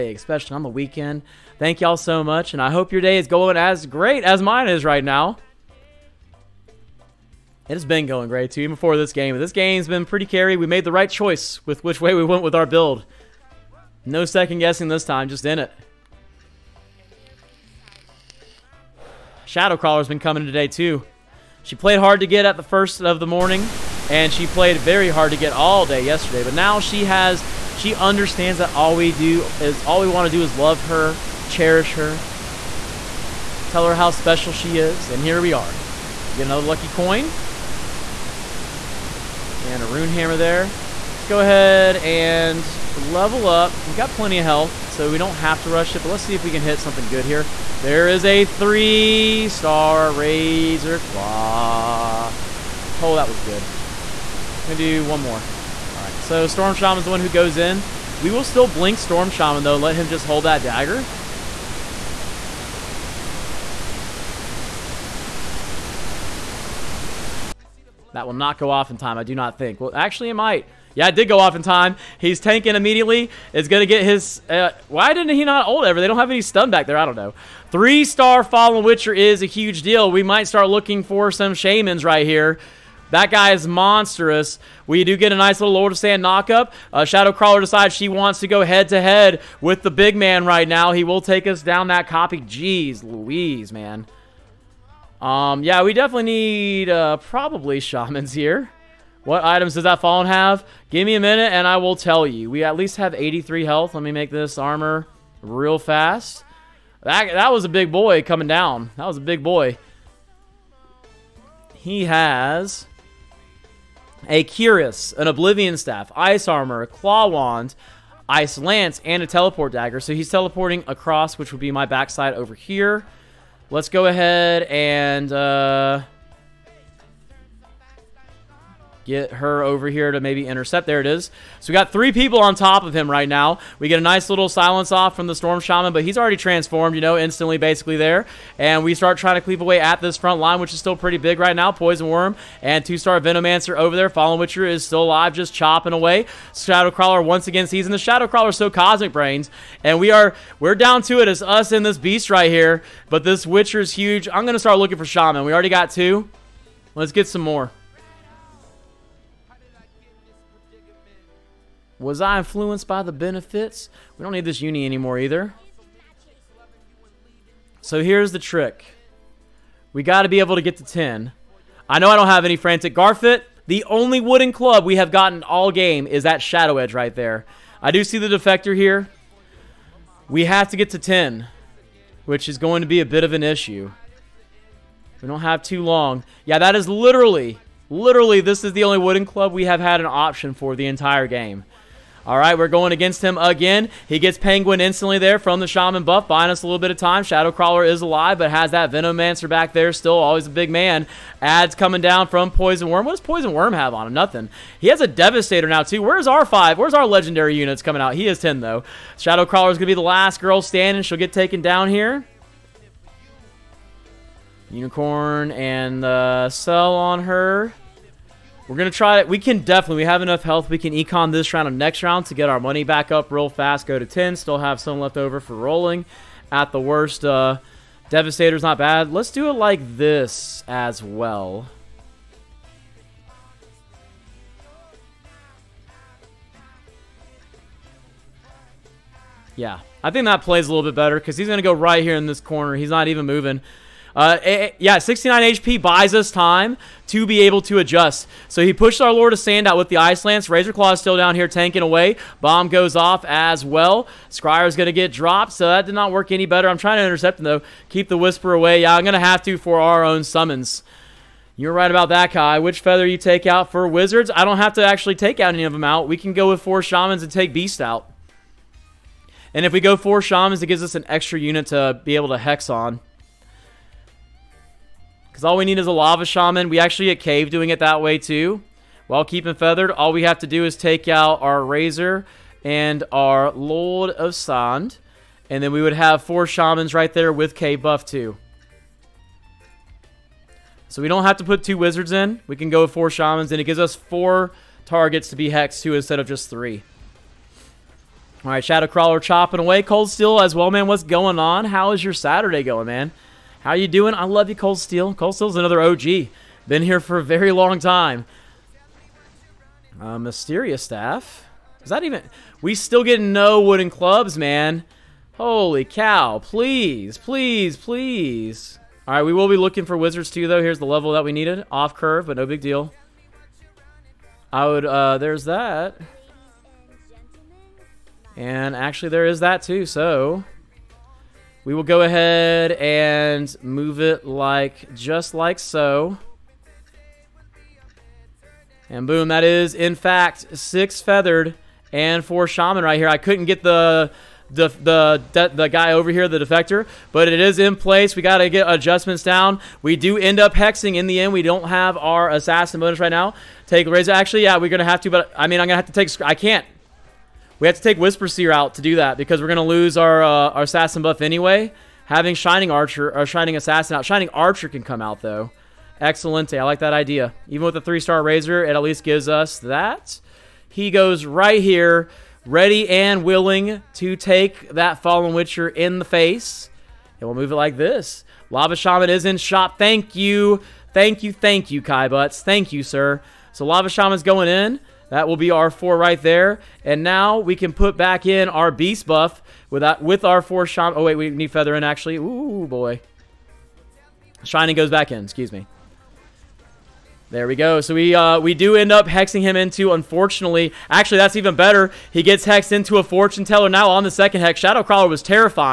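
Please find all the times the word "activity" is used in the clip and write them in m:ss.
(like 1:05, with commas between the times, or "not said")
not said.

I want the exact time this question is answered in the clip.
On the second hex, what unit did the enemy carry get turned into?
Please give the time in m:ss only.
6:43.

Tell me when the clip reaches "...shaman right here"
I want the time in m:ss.
5:42.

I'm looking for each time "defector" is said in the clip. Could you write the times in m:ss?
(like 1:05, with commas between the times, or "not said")
2:58, 5:46.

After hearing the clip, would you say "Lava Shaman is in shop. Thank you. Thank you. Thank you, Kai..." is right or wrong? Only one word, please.
right.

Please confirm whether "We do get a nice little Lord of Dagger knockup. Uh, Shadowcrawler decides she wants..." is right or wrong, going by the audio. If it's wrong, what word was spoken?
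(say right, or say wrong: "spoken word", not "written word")
wrong: "Sand", not "Dagger".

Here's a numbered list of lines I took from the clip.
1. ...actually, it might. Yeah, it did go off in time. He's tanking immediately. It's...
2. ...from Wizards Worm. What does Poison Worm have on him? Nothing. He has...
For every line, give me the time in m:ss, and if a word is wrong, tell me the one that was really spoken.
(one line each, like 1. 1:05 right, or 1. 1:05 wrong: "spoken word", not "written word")
1. 1:09 right
2. 3:22 wrong: "Poison", not "Wizards".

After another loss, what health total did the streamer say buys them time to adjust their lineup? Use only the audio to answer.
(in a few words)
69.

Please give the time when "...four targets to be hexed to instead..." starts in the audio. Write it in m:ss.
4:53.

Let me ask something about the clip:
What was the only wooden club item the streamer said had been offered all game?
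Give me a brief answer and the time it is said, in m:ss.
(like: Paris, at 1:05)
Shadow Edge, at 2:56.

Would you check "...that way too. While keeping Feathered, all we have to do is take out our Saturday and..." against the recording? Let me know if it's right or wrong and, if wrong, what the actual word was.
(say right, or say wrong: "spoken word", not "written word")
wrong: "Razor", not "Saturday".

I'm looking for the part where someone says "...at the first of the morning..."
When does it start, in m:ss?
0:22.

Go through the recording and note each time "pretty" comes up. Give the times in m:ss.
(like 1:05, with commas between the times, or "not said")
0:10, 2:20.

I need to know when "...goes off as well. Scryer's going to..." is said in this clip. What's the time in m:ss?
4:12.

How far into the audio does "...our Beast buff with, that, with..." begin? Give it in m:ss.
6:28.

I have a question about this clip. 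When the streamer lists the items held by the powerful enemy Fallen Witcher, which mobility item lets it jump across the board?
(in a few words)
Teleport Dagger.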